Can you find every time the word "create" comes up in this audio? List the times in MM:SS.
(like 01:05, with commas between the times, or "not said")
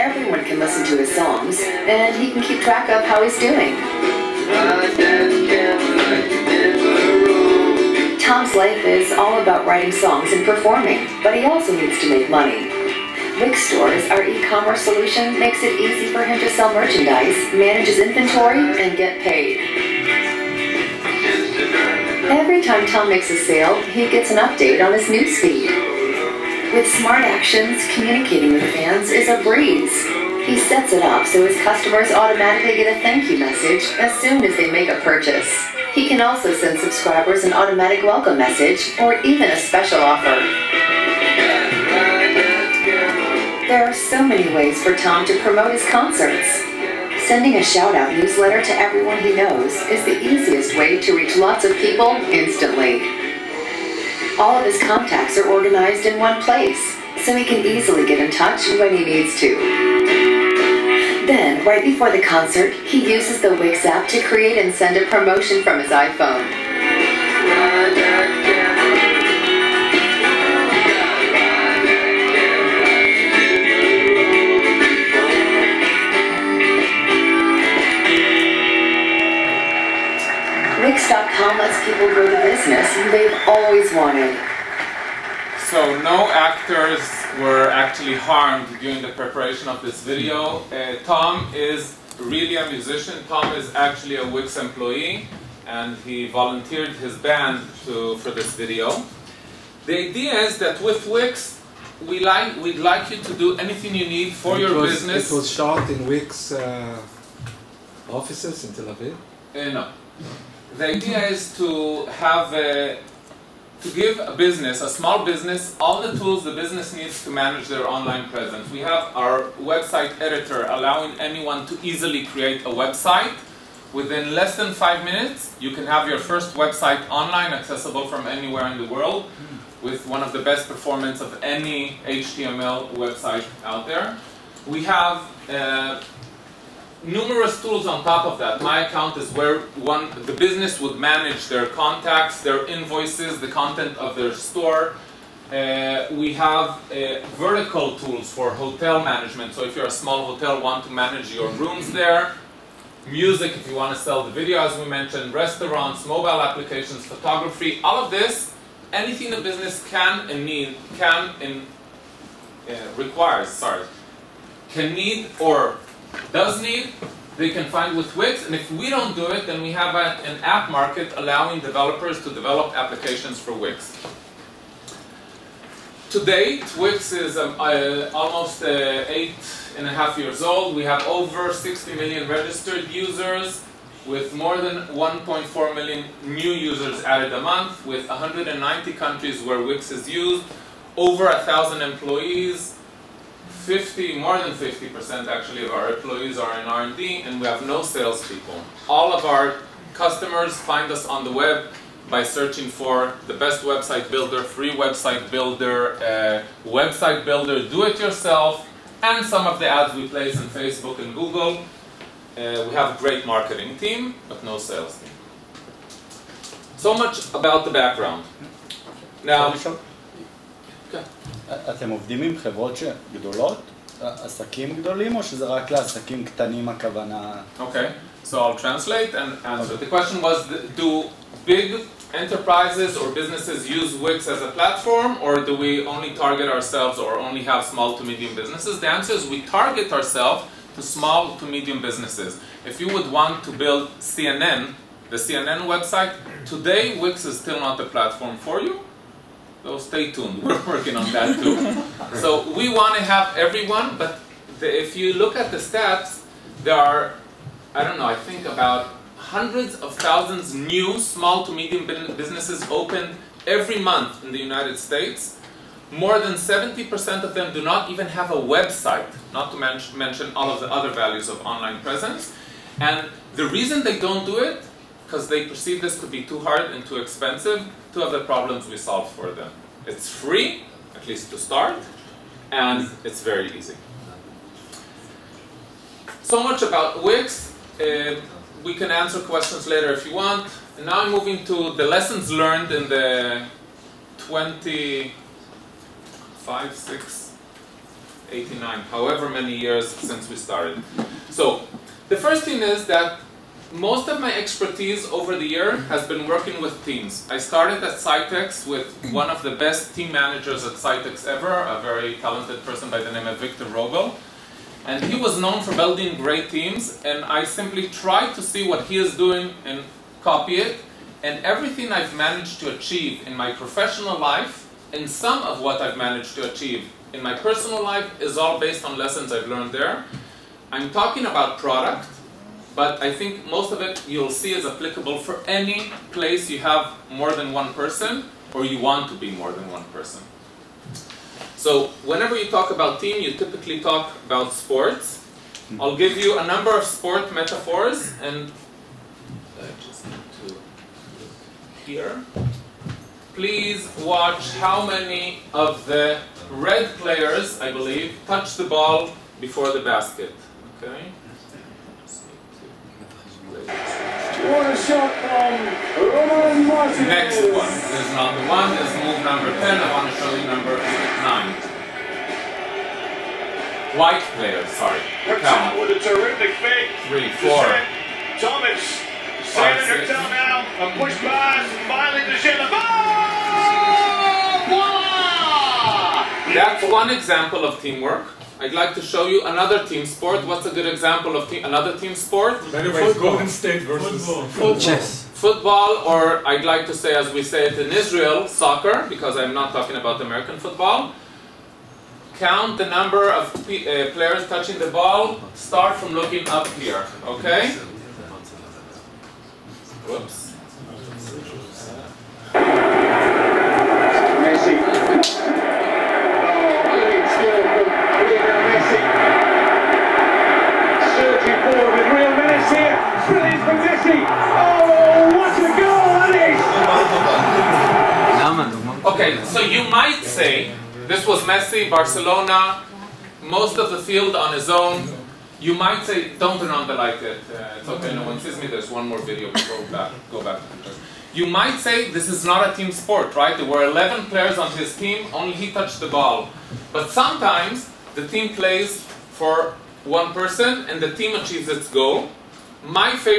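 01:04, 02:02.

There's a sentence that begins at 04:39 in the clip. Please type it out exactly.
It's free, at least to start, and it's very easy.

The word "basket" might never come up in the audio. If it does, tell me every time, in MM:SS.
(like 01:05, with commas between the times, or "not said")
05:59.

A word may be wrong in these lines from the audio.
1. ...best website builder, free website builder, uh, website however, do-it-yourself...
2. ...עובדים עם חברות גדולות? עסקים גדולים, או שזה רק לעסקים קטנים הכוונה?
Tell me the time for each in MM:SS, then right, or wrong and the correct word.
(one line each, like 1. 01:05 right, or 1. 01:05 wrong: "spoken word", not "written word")
1. 03:23 wrong: "builder", not "however"
2. 03:41 right.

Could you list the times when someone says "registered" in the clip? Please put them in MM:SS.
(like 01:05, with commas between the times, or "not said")
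03:02.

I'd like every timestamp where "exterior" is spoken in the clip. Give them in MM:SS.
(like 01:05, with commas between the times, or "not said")
not said.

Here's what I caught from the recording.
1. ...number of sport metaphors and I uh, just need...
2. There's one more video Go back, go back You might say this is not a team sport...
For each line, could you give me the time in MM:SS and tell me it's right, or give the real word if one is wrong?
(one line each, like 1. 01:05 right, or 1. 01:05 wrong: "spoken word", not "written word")
1. 05:46 right
2. 07:18 right.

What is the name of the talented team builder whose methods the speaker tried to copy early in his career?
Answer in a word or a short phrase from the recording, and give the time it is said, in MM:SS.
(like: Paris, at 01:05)
Victor Rogel, at 05:13.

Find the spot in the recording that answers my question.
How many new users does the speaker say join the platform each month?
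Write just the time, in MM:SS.
03:04.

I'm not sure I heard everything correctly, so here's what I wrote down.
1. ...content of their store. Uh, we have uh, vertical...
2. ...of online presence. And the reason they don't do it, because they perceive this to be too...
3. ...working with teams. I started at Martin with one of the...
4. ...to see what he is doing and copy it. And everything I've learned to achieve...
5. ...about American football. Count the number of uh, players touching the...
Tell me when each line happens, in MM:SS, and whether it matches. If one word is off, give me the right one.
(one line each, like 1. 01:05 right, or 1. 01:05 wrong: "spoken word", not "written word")
1. 02:23 right
2. 04:31 right
3. 05:06 wrong: "Scitex", not "Martin"
4. 05:18 wrong: "managed", not "learned"
5. 06:39 right.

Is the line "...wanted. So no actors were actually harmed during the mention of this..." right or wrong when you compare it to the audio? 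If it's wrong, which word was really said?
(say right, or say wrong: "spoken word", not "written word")
wrong: "preparation", not "mention".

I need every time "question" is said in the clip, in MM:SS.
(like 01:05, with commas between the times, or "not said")
03:49, 04:49.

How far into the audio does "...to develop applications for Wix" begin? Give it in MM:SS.
02:52.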